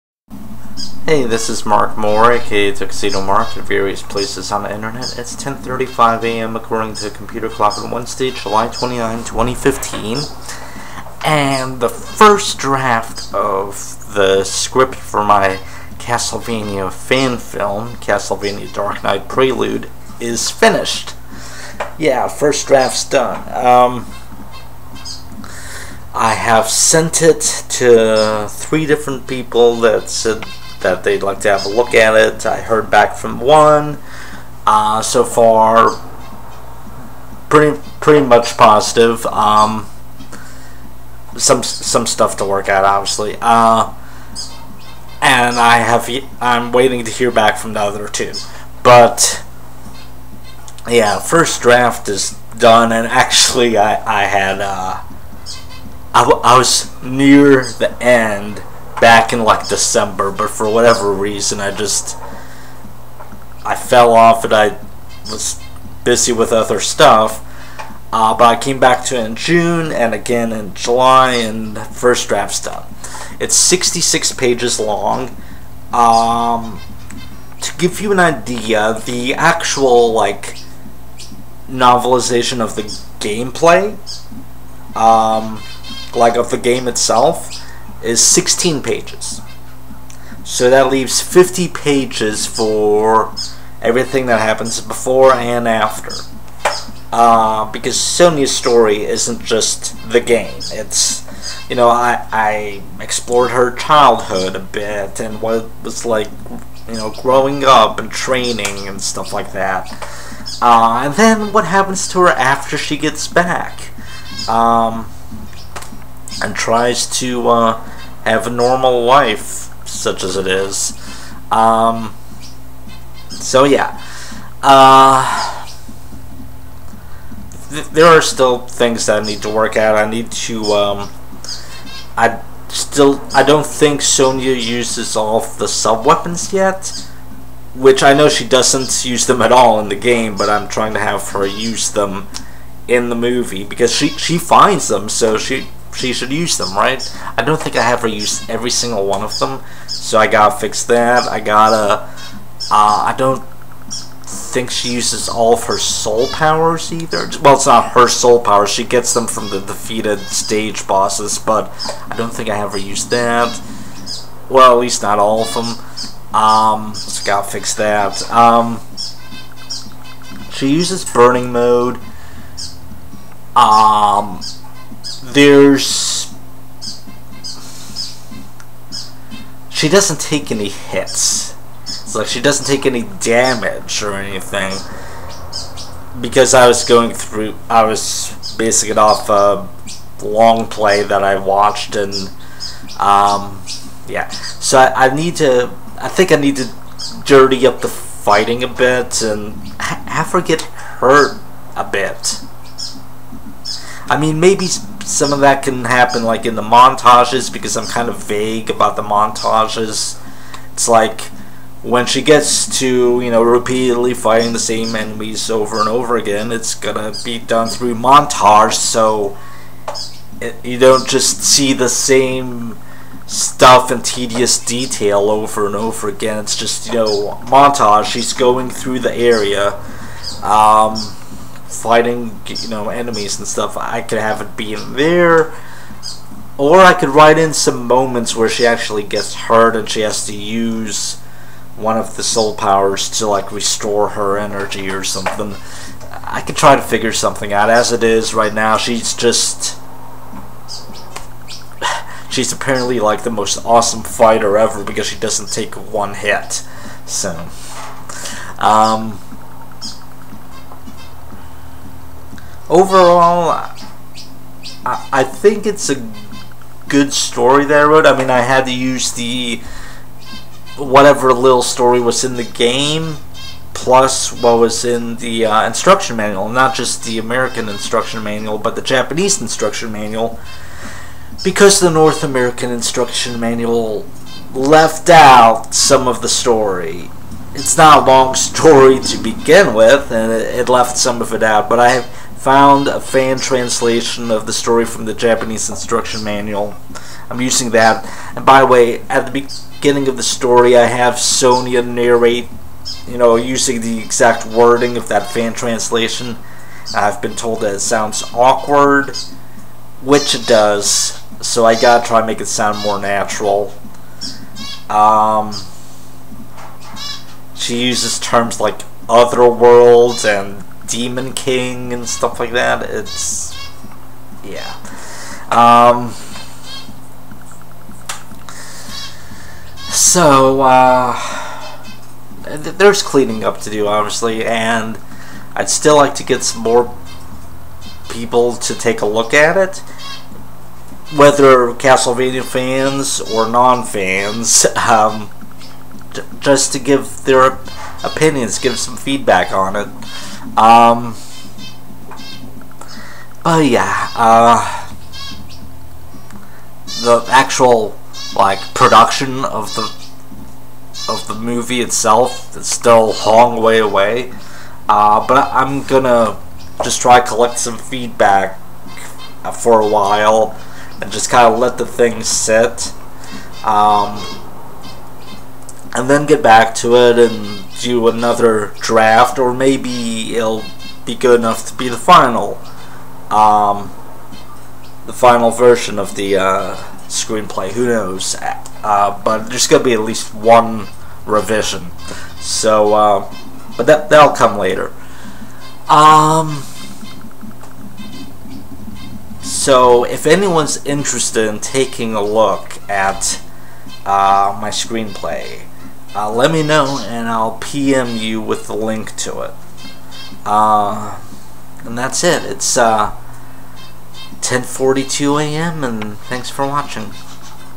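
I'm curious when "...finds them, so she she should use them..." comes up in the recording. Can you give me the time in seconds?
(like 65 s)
144 s.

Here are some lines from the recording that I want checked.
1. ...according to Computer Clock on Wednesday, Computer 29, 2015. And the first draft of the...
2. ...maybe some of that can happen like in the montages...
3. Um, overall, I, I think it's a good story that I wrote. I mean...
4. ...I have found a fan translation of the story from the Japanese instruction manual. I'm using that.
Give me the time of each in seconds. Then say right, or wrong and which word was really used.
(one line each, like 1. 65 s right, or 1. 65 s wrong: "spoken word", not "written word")
1. 6 s wrong: "July", not "Computer"
2. 204 s right
3. 258 s right
4. 291 s right.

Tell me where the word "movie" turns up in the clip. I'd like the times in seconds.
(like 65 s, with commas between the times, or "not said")
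143 s, 361 s.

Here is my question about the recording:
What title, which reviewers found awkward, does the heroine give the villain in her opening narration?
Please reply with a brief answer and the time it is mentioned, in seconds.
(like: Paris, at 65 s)
Demon King, at 320 s.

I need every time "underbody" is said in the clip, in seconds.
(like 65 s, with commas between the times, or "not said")
not said.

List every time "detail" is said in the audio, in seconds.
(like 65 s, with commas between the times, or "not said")
224 s.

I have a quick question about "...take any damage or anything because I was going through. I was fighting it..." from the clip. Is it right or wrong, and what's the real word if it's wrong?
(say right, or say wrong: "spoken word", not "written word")
wrong: "basing", not "fighting".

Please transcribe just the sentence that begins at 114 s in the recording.
Um, and tries to uh, have a normal life, such as it is.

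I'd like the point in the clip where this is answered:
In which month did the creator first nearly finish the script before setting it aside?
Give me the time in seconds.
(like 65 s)
59 s.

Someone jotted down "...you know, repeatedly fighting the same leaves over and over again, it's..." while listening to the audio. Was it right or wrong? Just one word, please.
wrong.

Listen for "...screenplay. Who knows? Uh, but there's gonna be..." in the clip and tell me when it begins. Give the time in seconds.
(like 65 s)
387 s.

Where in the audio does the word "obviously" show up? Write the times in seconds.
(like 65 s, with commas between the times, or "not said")
42 s, 333 s.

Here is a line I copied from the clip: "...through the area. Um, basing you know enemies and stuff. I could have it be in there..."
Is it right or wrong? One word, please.
wrong.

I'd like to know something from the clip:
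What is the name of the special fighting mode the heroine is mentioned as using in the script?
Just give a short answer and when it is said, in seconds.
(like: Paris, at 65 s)
burning mode, at 171 s.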